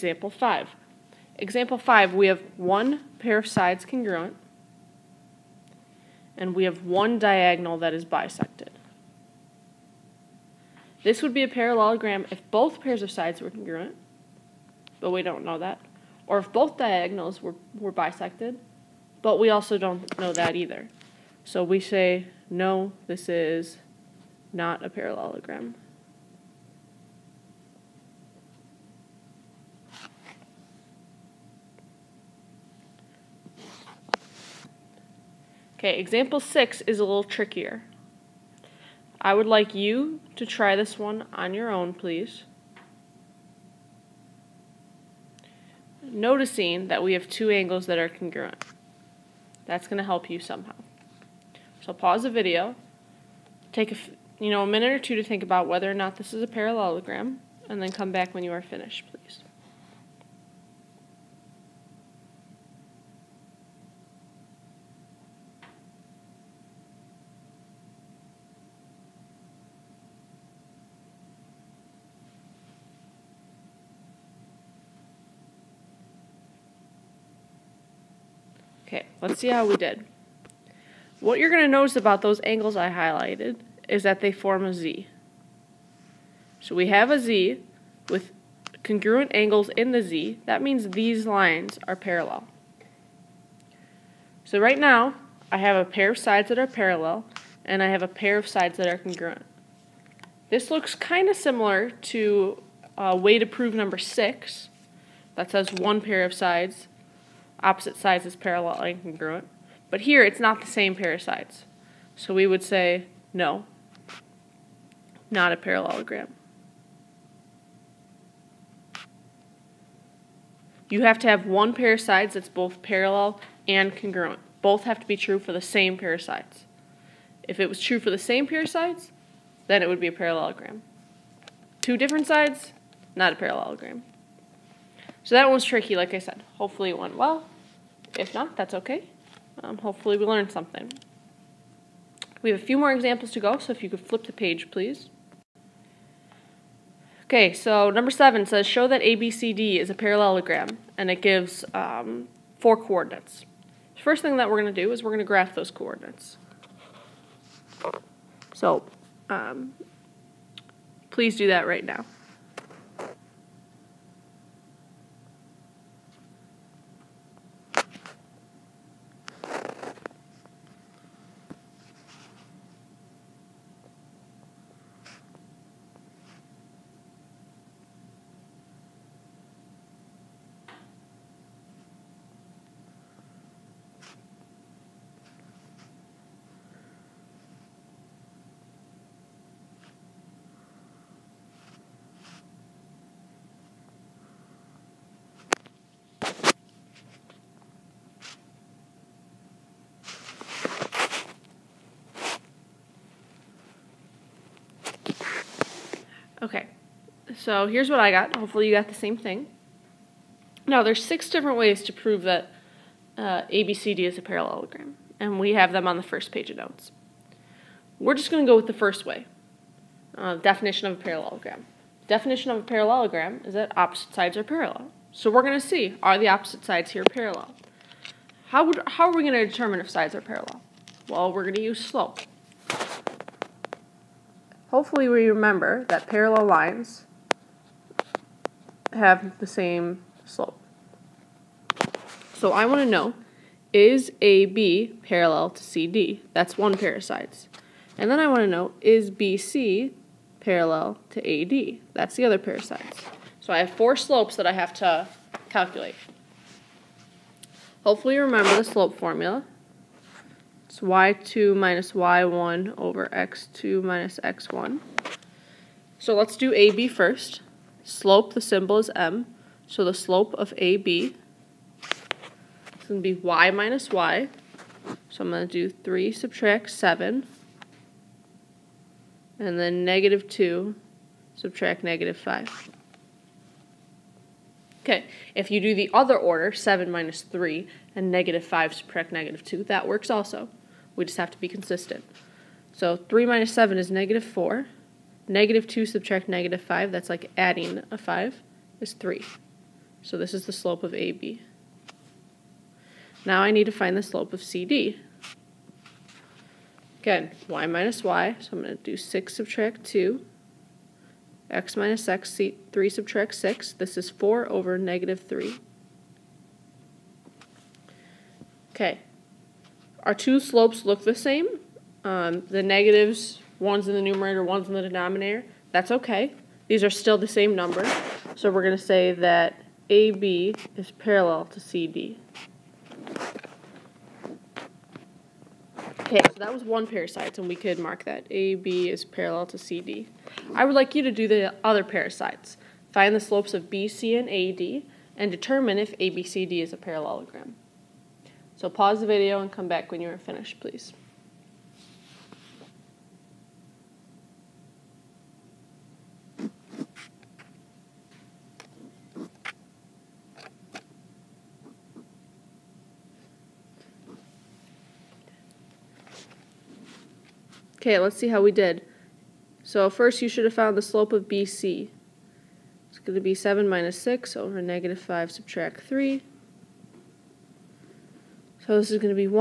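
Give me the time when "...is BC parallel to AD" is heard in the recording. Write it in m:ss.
4:08.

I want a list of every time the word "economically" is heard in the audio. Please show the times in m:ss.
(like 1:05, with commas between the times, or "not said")
not said.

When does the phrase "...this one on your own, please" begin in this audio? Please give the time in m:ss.
0:40.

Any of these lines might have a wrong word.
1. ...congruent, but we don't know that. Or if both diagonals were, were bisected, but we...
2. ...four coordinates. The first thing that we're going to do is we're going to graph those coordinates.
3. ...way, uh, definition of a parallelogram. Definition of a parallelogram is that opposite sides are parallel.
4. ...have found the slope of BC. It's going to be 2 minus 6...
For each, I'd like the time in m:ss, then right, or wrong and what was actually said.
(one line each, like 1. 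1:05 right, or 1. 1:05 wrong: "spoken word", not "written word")
1. 0:13 right
2. 2:32 right
3. 3:39 right
4. 6:10 wrong: "7", not "2".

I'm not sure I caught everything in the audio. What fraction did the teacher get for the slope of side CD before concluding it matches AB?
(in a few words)
4/-3.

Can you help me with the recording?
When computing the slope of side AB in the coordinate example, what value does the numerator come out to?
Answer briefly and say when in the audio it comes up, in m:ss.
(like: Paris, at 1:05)
-4, at 4:53.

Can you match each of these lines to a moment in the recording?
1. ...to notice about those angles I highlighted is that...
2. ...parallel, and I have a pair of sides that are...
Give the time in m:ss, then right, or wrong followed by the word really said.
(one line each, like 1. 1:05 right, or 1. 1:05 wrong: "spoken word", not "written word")
1. 1:21 right
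2. 1:36 right.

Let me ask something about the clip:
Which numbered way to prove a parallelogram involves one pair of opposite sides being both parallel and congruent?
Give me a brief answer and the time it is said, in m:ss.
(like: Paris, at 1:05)
6, at 1:43.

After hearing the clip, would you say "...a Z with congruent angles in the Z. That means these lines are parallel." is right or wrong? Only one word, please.
right.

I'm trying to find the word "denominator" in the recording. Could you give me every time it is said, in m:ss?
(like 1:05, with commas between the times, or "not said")
5:24.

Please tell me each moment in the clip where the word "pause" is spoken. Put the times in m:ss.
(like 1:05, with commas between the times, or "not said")
0:51, 5:48.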